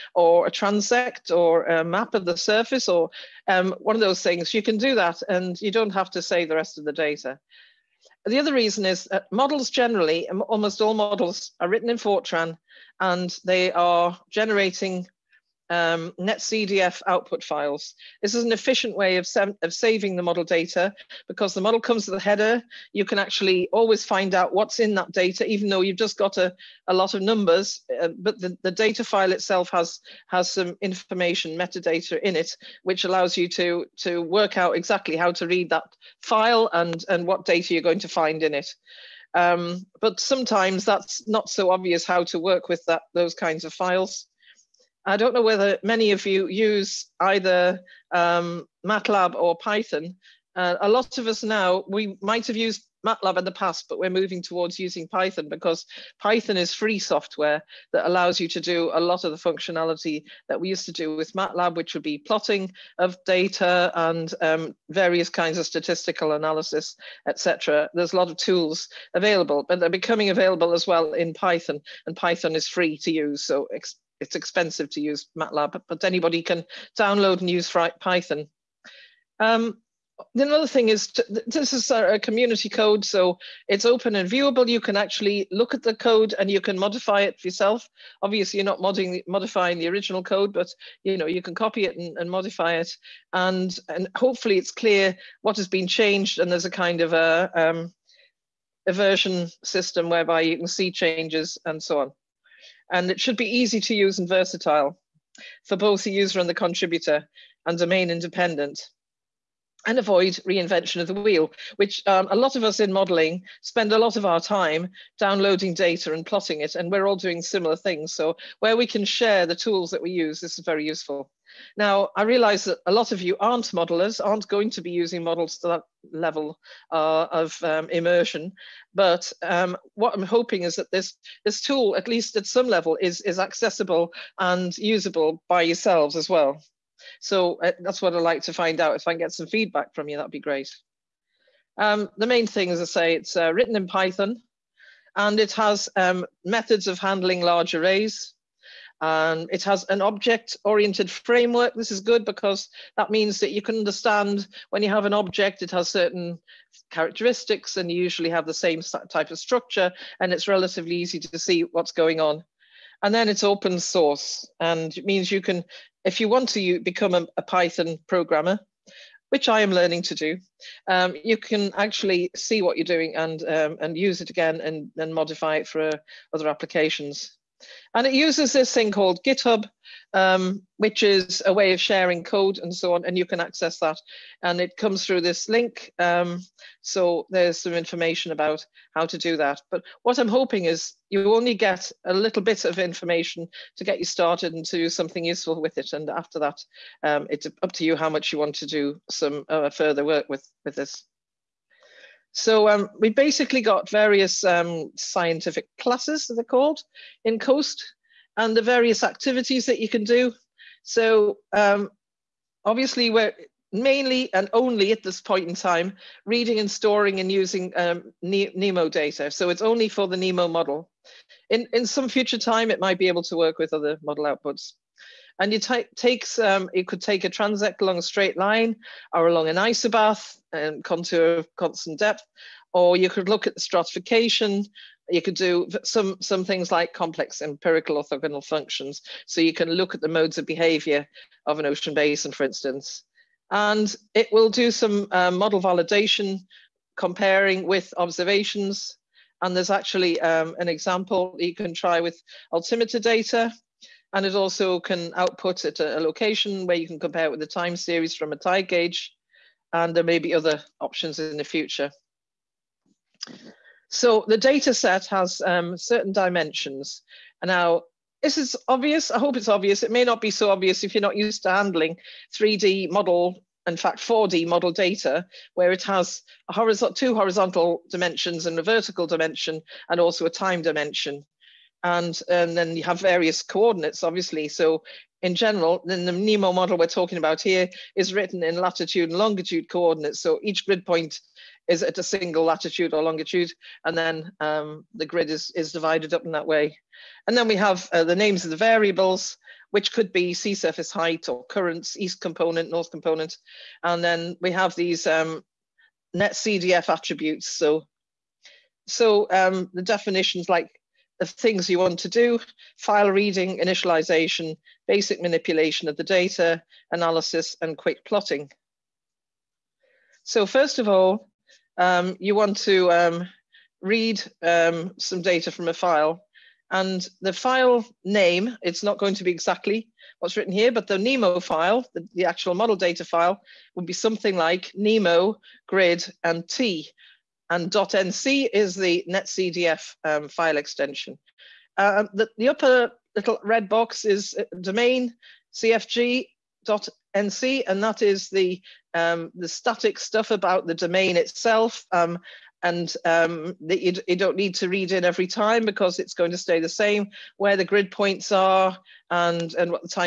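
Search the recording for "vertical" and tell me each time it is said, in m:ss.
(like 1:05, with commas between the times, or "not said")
4:38.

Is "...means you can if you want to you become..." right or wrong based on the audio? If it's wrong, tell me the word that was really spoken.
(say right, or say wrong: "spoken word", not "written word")
right.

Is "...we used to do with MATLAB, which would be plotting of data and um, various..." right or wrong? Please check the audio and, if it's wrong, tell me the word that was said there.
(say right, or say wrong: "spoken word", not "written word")
right.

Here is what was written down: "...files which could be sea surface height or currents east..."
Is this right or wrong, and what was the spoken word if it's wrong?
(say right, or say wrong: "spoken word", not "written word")
wrong: "variables", not "files".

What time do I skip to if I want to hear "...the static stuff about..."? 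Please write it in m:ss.
5:49.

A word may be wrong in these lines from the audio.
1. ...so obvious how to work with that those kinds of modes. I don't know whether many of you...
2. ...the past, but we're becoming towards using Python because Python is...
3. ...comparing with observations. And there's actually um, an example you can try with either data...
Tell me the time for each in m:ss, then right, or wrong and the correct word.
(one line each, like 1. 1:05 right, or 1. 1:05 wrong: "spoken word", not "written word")
1. 0:41 wrong: "files", not "modes"
2. 0:53 wrong: "moving", not "becoming"
3. 4:06 wrong: "altimeter", not "either".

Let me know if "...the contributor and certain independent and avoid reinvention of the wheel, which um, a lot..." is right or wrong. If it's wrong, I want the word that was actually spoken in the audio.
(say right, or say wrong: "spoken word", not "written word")
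wrong: "domain", not "certain".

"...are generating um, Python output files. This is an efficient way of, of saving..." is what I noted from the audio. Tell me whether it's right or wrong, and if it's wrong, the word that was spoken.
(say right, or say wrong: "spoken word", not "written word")
wrong: "NetCDF", not "Python".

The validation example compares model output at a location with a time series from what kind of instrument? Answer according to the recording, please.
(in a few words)
tide gauge.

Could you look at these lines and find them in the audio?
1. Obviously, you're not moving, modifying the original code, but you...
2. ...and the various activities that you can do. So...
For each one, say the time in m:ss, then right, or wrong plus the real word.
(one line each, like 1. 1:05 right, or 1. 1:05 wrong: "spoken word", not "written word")
1. 1:28 wrong: "modding", not "moving"
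2. 3:28 right.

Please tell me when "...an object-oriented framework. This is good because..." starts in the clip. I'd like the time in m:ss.
2:29.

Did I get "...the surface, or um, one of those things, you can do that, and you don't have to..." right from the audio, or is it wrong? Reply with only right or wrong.
right.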